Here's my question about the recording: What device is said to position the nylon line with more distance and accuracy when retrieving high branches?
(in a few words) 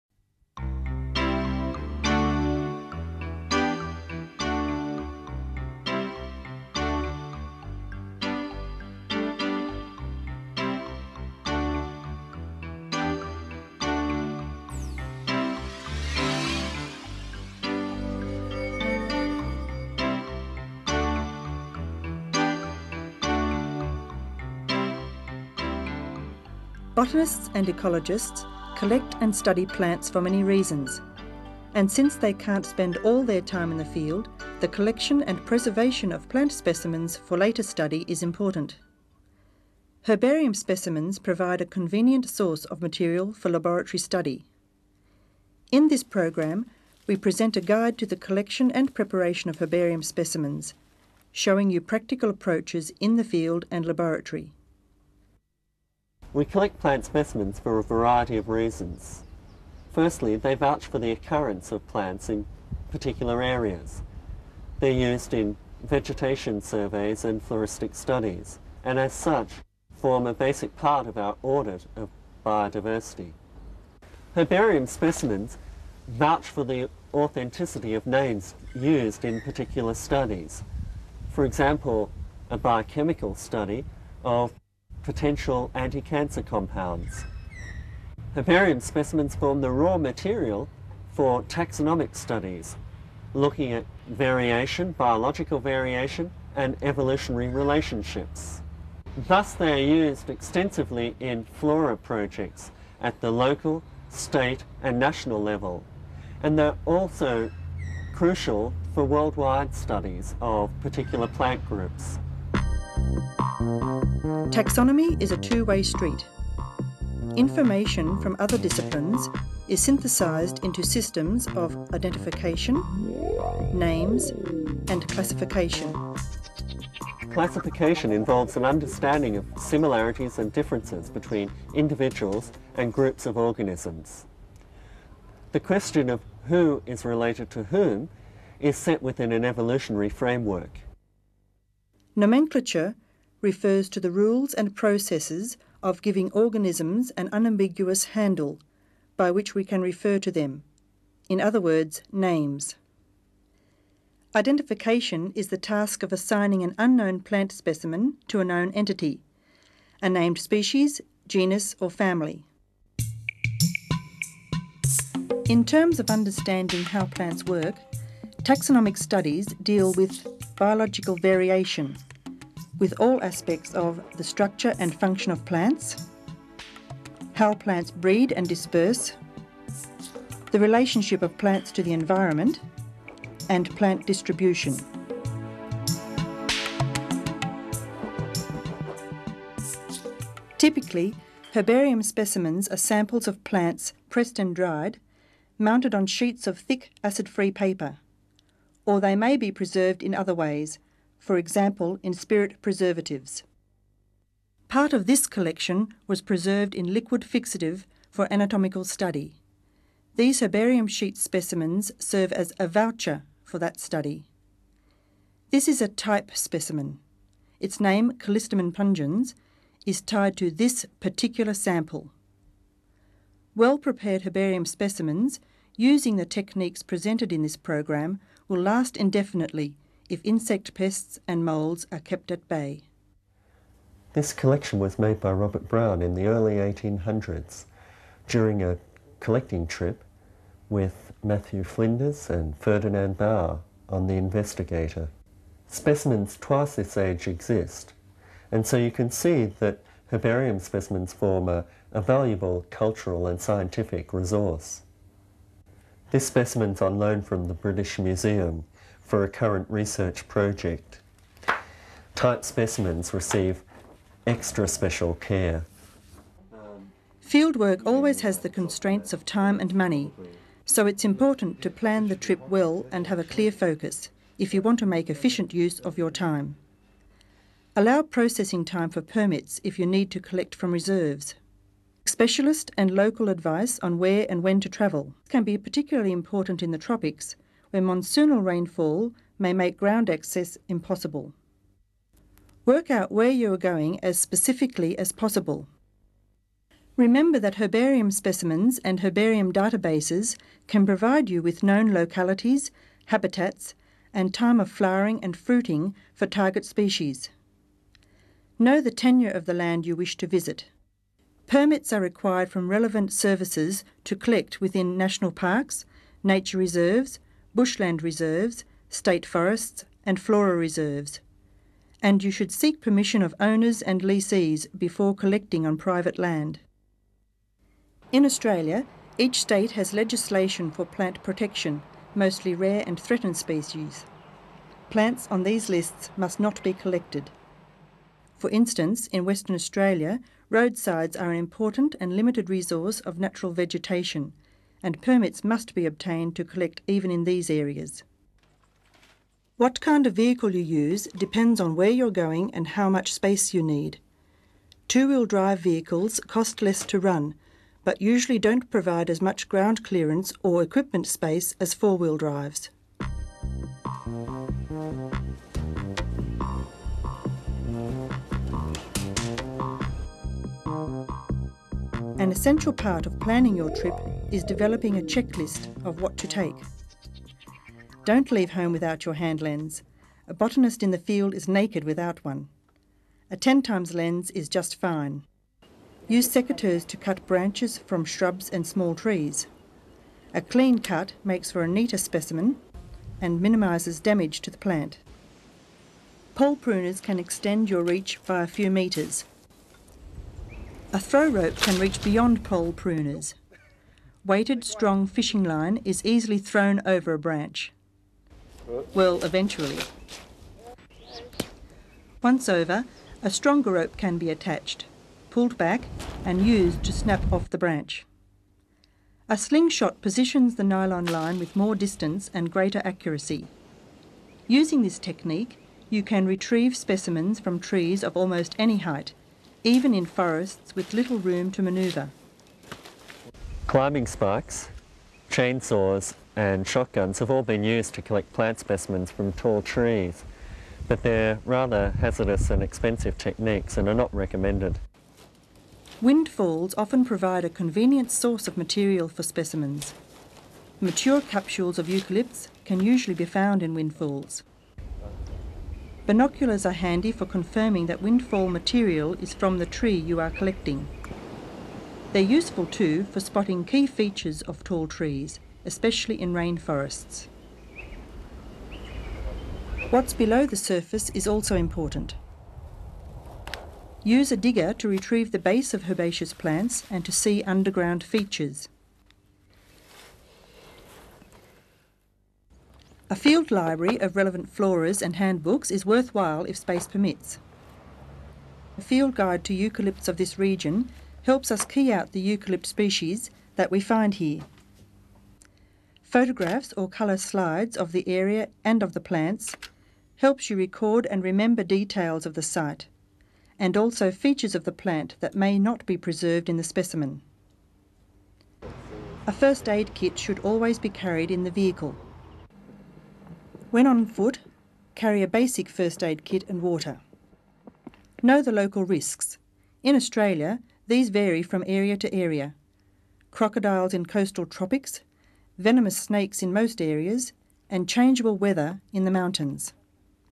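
A slingshot.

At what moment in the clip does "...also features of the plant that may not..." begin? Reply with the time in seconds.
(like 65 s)
503 s.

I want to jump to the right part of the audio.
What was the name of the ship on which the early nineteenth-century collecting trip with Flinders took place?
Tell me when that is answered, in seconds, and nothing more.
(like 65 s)
244 s.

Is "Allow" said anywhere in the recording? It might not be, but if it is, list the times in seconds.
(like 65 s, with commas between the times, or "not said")
277 s.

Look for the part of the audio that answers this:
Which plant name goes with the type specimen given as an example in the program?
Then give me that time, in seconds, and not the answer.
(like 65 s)
218 s.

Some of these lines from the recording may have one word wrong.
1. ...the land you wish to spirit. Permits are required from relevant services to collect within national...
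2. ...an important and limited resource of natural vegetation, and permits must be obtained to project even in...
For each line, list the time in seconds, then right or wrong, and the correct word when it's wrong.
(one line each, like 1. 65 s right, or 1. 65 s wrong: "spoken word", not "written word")
1. 309 s wrong: "visit", not "spirit"
2. 341 s wrong: "collect", not "project".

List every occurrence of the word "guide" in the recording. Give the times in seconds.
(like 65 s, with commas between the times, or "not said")
47 s, 489 s.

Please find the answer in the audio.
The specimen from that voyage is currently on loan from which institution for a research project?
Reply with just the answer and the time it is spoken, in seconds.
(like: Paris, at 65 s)
British Museum, at 257 s.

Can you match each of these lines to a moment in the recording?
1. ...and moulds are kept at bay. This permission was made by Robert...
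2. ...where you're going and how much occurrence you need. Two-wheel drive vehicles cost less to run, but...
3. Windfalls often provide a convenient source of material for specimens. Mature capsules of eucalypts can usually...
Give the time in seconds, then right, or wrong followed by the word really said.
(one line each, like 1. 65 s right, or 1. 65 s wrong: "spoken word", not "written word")
1. 231 s wrong: "collection", not "permission"
2. 351 s wrong: "space", not "occurrence"
3. 446 s right.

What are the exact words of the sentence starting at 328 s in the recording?
In Australia, each state has legislation for plant protection, mostly rare and threatened species.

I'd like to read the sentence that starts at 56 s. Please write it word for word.
We collect plant specimens for a variety of reasons.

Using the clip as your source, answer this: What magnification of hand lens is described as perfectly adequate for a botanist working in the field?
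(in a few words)
10 times.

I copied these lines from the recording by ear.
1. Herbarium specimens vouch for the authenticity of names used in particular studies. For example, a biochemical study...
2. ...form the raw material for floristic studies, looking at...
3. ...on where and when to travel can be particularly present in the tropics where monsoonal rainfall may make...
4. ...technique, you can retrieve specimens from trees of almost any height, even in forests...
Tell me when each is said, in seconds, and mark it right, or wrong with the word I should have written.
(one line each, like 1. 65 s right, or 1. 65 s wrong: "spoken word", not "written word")
1. 74 s right
2. 89 s wrong: "taxonomic", not "floristic"
3. 283 s wrong: "important", not "present"
4. 424 s right.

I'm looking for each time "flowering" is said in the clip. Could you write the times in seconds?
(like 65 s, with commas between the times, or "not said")
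304 s.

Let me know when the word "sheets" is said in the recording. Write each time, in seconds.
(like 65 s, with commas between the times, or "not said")
196 s, 210 s.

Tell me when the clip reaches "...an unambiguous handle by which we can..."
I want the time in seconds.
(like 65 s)
147 s.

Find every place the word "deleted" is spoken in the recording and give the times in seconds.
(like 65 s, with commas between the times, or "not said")
not said.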